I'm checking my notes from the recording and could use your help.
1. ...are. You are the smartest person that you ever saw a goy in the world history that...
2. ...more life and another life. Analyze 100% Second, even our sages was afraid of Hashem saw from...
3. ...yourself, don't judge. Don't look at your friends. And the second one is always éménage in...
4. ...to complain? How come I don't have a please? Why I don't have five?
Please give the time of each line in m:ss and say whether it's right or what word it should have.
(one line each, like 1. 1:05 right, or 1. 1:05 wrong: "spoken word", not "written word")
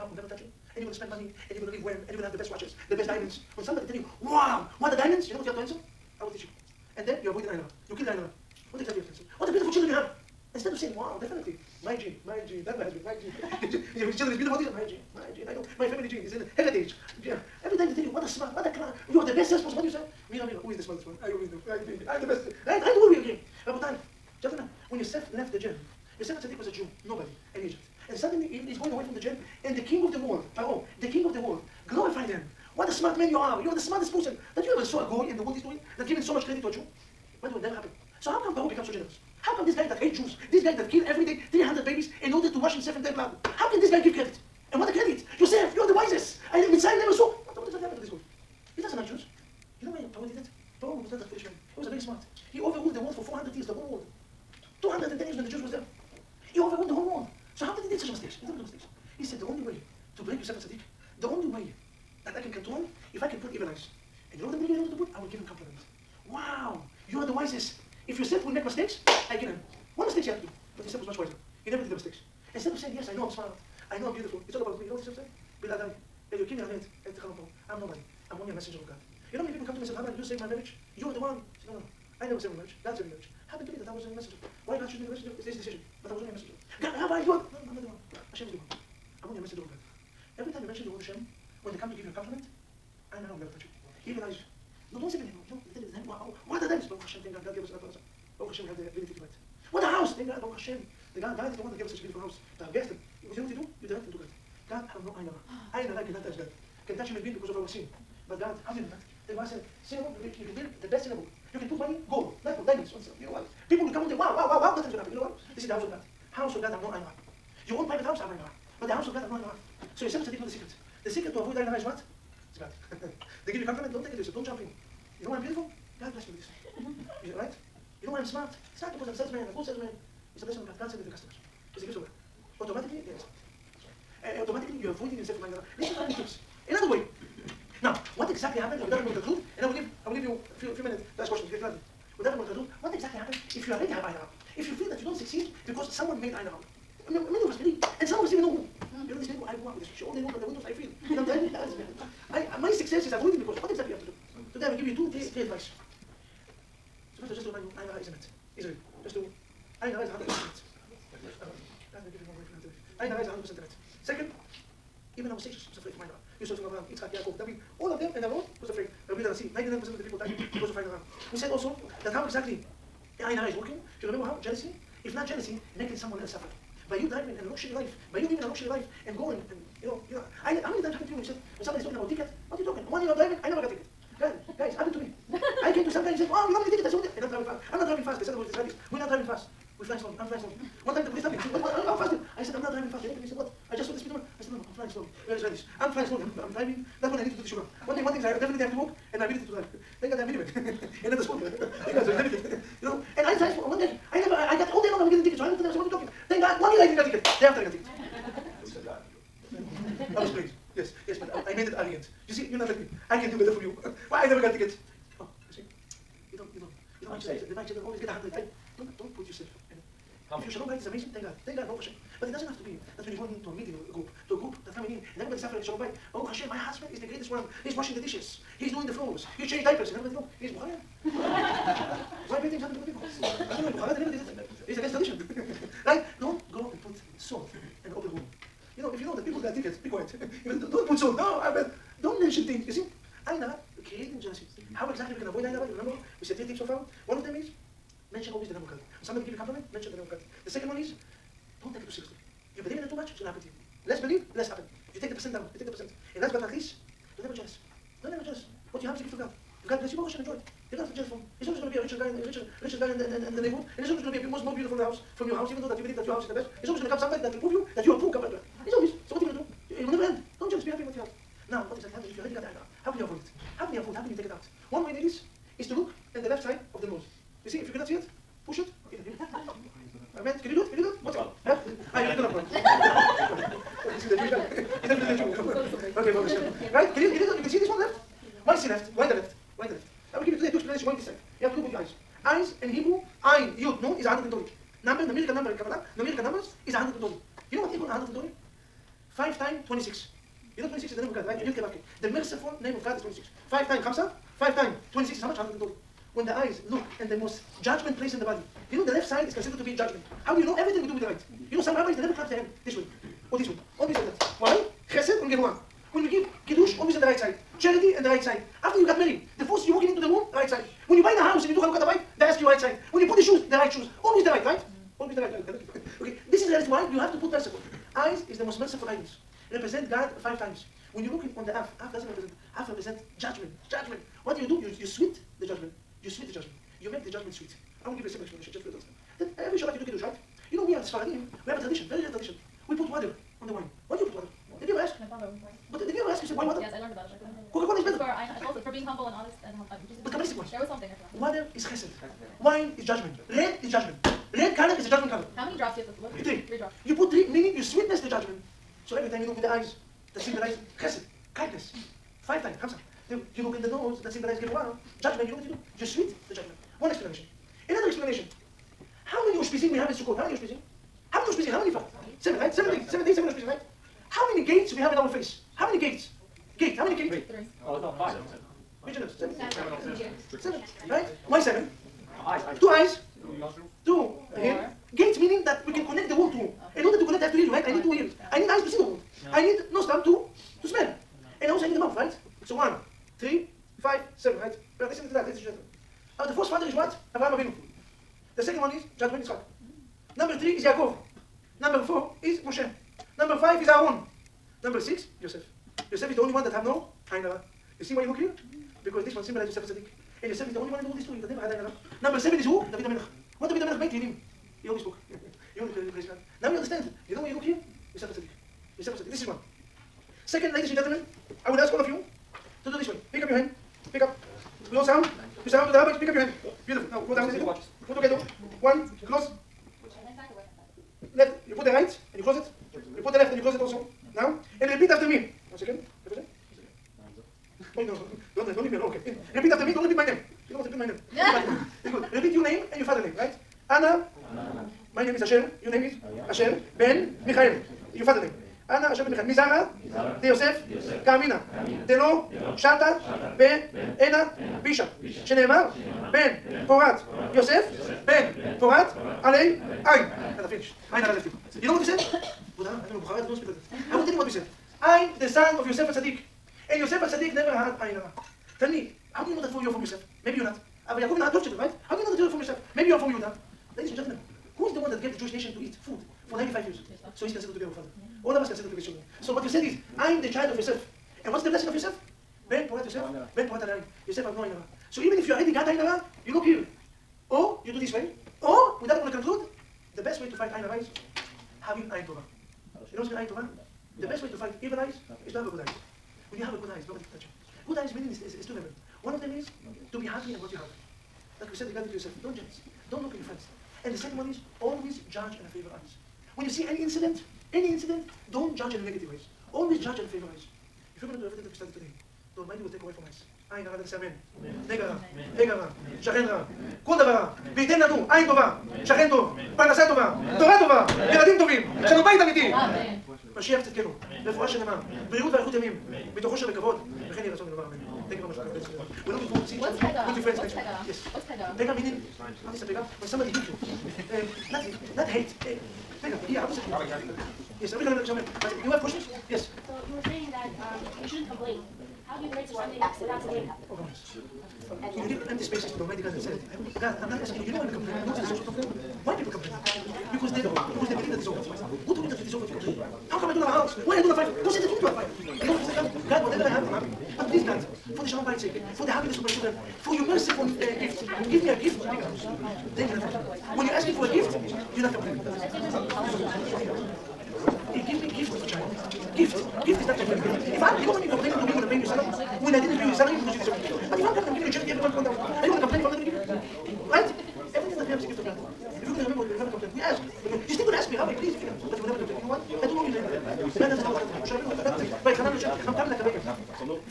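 1. 0:33 right
2. 2:42 wrong: "You", not "Hashem"
3. 8:21 wrong: "judge", not "éménage"
4. 9:12 wrong: "house", not "please".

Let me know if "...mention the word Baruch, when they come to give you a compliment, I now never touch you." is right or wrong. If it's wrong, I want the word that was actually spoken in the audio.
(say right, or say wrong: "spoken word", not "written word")
wrong: "Hashem", not "Baruch".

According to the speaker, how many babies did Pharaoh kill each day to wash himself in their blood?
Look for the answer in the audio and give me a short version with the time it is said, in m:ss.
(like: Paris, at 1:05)
300, at 0:41.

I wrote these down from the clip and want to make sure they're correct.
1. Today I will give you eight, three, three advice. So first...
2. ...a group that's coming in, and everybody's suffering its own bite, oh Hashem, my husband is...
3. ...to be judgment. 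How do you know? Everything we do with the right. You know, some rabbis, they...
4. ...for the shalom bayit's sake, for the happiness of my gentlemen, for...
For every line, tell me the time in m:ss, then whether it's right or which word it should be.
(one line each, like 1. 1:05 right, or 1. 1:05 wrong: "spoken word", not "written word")
1. 2:34 wrong: "two", not "eight"
2. 3:44 right
3. 5:09 right
4. 9:17 wrong: "children", not "gentlemen".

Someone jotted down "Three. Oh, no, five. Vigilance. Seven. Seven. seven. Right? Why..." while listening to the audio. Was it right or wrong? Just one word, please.
right.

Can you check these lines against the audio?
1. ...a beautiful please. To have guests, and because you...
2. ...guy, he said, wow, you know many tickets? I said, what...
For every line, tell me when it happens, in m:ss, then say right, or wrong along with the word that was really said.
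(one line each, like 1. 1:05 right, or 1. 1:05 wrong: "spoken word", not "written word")
1. 1:42 wrong: "house", not "please"
2. 3:06 right.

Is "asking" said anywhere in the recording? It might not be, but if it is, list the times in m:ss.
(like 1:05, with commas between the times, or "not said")
9:07, 9:23.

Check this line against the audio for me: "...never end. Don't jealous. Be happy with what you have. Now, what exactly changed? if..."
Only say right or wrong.
wrong.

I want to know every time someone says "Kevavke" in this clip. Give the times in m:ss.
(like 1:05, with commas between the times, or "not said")
5:01.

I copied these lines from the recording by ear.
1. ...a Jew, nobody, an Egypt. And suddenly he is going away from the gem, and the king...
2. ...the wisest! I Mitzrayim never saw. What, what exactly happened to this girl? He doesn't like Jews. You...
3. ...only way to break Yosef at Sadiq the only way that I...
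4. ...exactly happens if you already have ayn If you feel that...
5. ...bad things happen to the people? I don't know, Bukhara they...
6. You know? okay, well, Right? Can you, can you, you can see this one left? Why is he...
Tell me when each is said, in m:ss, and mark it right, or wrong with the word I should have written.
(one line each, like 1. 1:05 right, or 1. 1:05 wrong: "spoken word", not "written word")
1. 0:26 right
2. 0:45 right
3. 0:59 right
4. 2:22 right
5. 3:52 right
6. 4:45 right.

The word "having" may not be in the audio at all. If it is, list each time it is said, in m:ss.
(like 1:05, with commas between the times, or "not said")
8:11.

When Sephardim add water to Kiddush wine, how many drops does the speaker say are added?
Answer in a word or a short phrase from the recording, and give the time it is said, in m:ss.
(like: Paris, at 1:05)
3, at 5:56.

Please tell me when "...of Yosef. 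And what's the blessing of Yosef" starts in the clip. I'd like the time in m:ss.
8:00.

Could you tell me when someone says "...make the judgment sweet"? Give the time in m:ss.
5:36.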